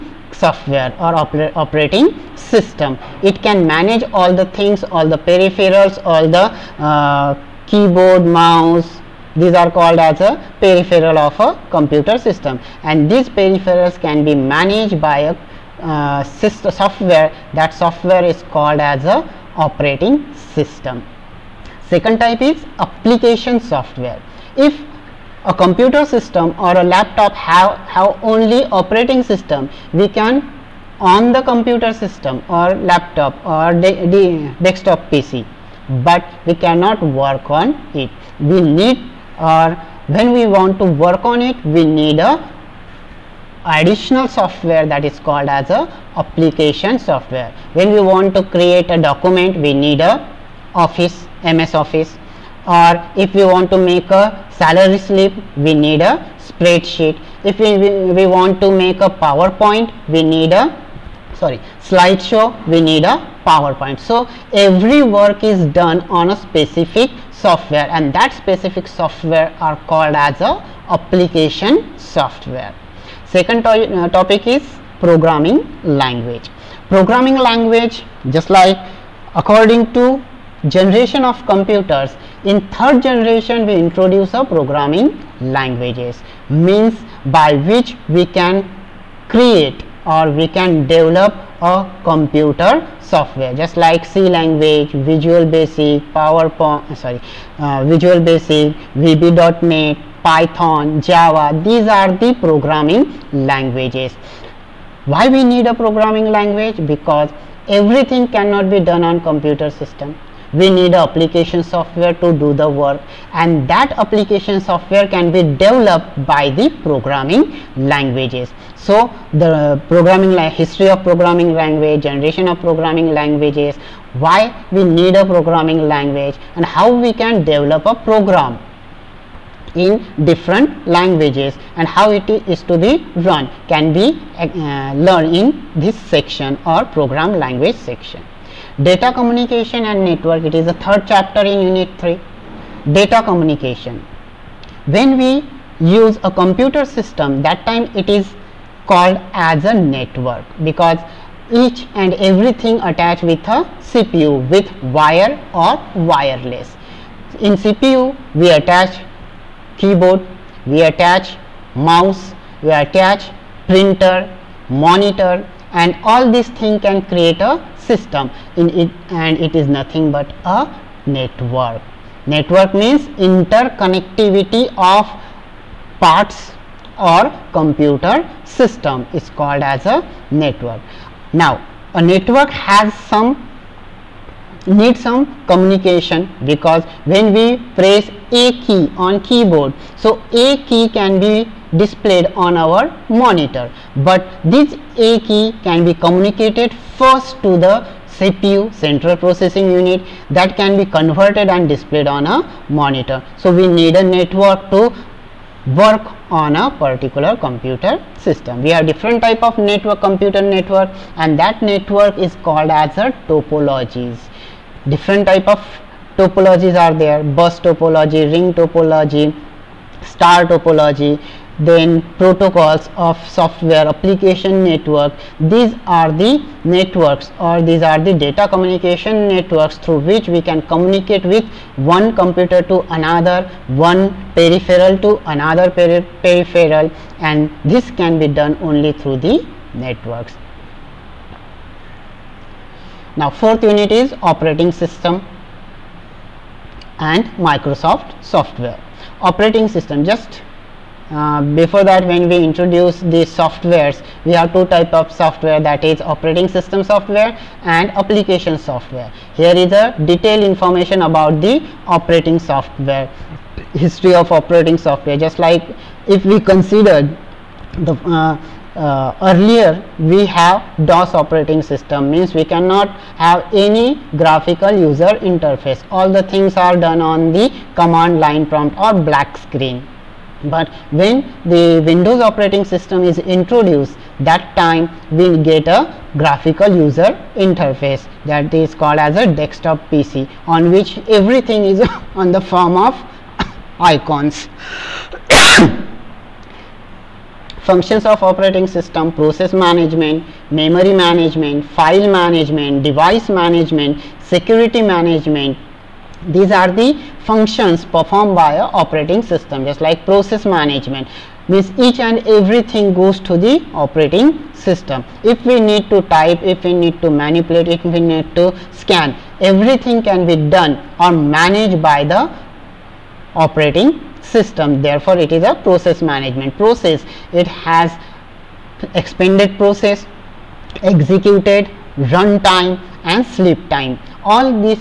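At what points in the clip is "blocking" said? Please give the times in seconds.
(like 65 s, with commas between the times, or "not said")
not said.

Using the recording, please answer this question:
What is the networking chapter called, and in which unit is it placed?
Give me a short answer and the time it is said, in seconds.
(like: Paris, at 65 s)
Data communication and network, unit 3, at 141 s.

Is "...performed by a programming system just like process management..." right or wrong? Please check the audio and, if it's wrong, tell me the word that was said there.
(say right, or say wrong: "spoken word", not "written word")
wrong: "operating", not "programming".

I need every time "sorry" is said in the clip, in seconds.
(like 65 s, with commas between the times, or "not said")
61 s, 96 s.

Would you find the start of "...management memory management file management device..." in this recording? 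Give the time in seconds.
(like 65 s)
299 s.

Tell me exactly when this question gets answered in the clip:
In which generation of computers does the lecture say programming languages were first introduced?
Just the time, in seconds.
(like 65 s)
82 s.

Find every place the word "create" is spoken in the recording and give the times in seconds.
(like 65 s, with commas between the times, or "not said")
48 s, 89 s, 167 s.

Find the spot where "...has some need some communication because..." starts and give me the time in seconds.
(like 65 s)
182 s.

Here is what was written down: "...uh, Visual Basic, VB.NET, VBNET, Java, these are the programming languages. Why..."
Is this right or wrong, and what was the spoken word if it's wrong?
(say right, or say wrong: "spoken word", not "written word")
wrong: "Python", not "VBNET".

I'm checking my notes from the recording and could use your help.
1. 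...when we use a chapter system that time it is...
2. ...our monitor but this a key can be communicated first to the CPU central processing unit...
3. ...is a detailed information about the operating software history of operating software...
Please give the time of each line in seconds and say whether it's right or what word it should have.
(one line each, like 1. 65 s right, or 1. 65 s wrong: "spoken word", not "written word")
1. 144 s wrong: "computer", not "chapter"
2. 192 s right
3. 259 s right.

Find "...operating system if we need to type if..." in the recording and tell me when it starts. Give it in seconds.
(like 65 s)
313 s.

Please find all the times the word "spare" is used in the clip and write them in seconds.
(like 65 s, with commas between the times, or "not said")
not said.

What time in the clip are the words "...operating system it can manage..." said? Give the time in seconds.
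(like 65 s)
1 s.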